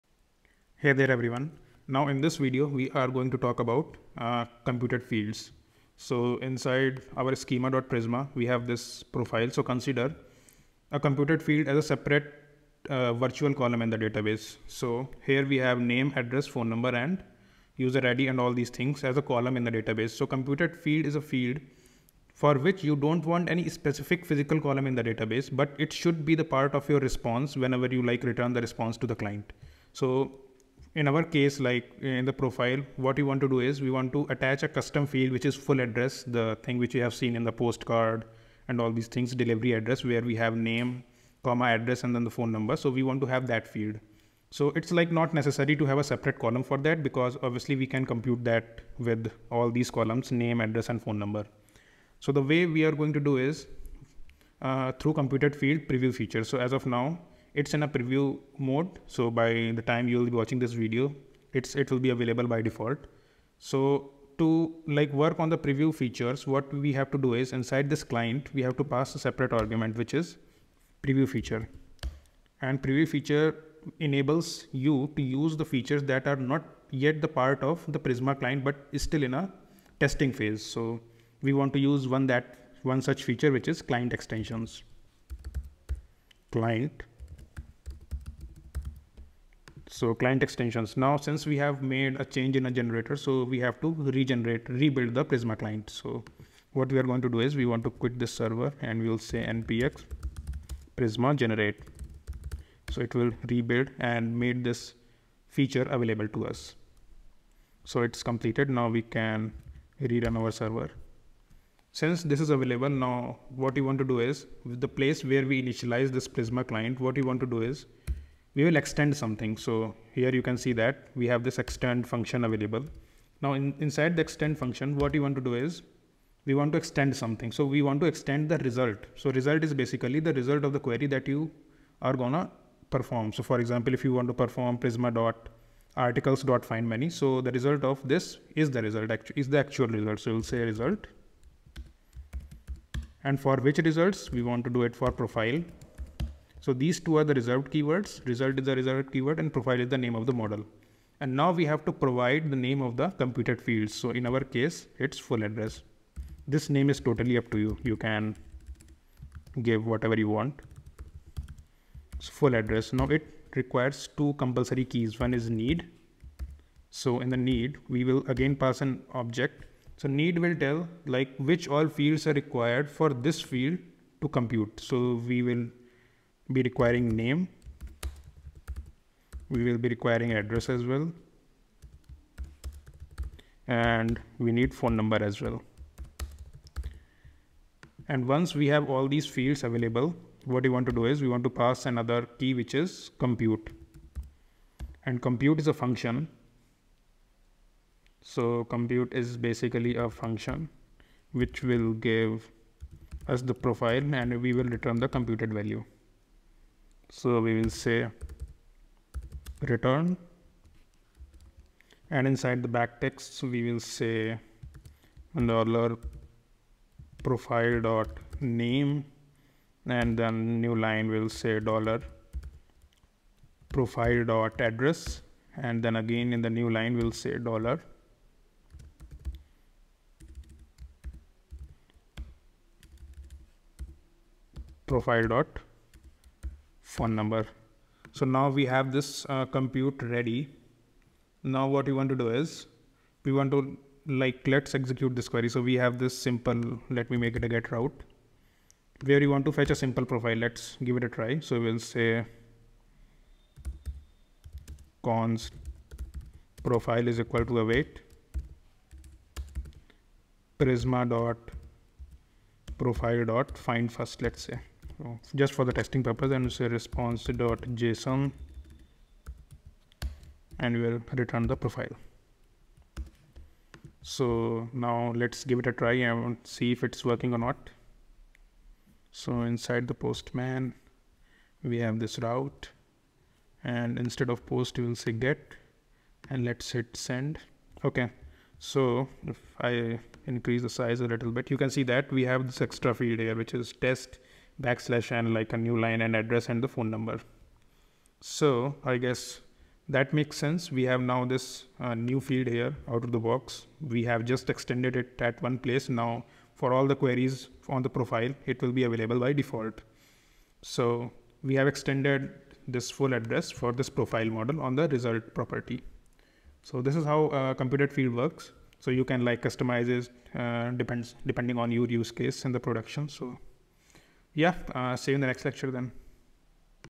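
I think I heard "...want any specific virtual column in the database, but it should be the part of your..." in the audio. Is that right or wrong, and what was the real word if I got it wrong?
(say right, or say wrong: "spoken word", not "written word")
wrong: "physical", not "virtual".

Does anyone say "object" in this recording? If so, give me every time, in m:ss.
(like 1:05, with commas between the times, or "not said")
2:49.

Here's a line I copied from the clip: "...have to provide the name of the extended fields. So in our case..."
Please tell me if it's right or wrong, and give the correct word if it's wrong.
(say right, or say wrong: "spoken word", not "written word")
wrong: "computed", not "extended".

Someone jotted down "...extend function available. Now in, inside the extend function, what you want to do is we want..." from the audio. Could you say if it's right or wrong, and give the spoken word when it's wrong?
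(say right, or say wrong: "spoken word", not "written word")
right.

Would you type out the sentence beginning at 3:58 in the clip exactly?
So now we have this uh, compute ready.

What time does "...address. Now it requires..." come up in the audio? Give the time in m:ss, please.
2:42.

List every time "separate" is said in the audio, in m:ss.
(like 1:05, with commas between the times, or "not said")
0:11, 0:46, 1:09.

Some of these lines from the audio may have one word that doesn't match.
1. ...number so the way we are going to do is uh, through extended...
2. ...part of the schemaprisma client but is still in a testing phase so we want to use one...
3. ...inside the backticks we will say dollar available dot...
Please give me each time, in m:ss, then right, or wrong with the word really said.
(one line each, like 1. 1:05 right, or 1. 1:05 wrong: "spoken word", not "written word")
1. 0:51 wrong: "computed", not "extended"
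2. 1:17 wrong: "prisma", not "schemaprisma"
3. 3:32 wrong: "profile", not "available".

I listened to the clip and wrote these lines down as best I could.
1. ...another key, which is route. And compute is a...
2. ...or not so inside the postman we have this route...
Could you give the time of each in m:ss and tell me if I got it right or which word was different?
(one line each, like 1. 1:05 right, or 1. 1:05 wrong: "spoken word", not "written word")
1. 3:11 wrong: "compute", not "route"
2. 4:37 right.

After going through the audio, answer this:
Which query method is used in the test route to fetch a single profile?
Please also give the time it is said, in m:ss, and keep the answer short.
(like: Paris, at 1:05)
find first, at 4:23.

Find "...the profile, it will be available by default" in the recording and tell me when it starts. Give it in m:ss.
5:07.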